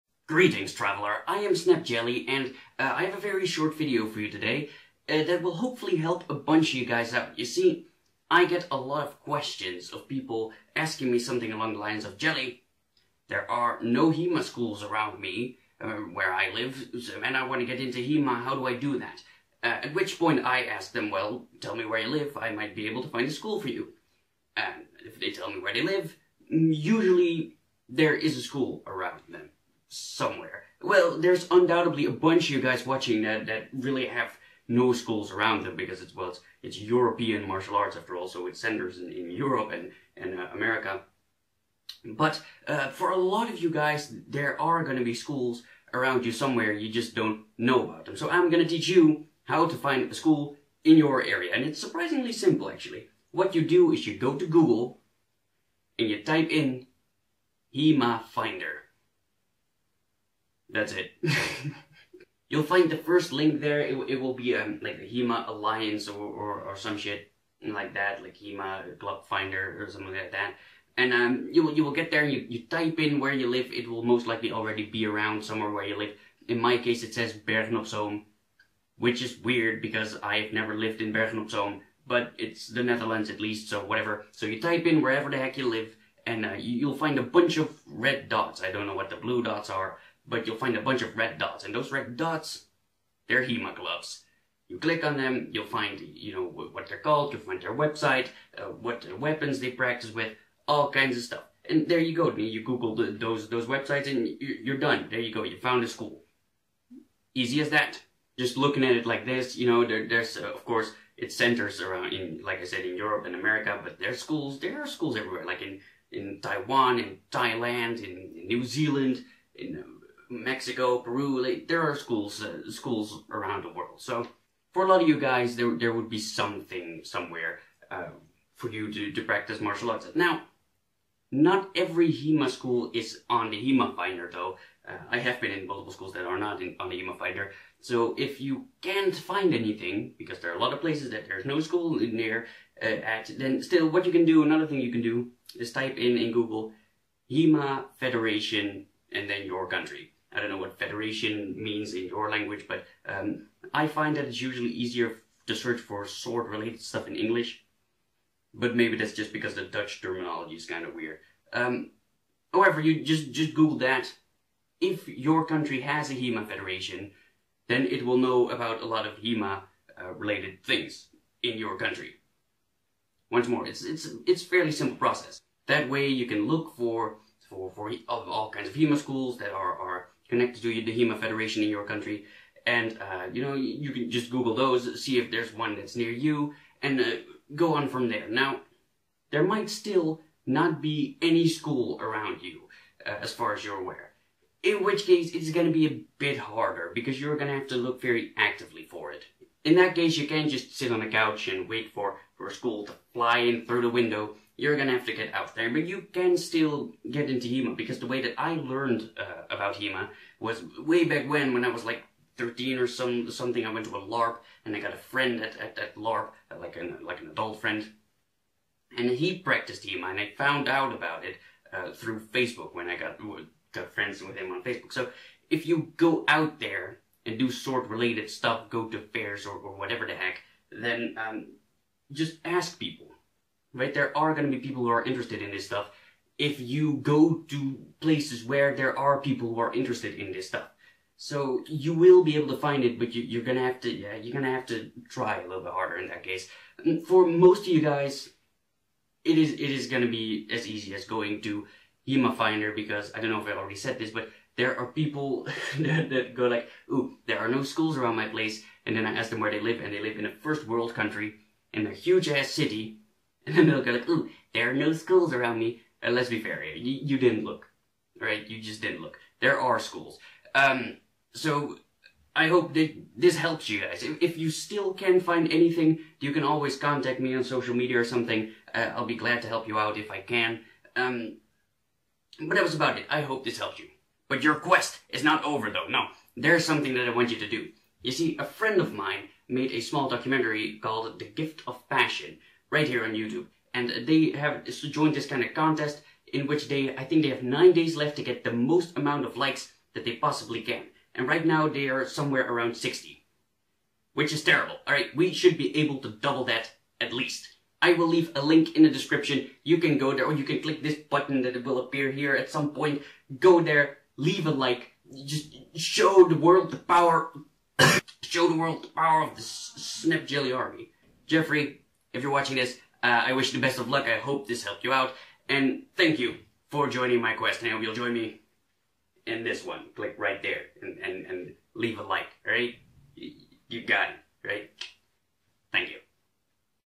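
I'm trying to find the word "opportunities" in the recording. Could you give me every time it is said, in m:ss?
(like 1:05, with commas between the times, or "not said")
not said.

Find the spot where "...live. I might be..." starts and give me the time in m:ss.
0:22.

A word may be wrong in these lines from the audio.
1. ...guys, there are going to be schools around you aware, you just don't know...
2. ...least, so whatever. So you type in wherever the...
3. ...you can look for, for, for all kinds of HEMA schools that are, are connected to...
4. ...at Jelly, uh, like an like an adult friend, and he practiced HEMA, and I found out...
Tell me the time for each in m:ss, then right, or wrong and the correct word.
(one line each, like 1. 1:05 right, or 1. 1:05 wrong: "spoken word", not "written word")
1. 0:43 wrong: "somewhere", not "aware"
2. 1:23 right
3. 2:56 right
4. 3:35 wrong: "LARP", not "Jelly".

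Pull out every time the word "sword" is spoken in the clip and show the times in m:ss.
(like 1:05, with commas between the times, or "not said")
2:36, 3:47.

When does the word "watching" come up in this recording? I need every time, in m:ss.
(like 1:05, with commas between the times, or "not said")
0:32, 5:22.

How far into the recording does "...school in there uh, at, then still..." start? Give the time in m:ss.
2:21.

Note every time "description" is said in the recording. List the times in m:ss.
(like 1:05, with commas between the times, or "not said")
5:08.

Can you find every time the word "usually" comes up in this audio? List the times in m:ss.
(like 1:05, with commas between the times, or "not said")
0:26, 2:34.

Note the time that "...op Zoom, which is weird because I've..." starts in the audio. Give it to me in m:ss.
1:17.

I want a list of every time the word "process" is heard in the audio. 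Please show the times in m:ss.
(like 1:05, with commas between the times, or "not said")
2:54.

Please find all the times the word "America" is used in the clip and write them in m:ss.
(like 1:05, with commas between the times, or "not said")
0:40, 1:53.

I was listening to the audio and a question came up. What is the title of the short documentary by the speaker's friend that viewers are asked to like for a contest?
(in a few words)
The Gift of Passion.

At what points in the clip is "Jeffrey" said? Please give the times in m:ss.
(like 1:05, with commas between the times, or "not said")
5:21.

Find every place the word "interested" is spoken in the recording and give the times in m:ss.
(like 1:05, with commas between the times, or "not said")
3:55, 3:59.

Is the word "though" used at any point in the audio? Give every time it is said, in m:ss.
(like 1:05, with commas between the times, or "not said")
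2:14, 4:45.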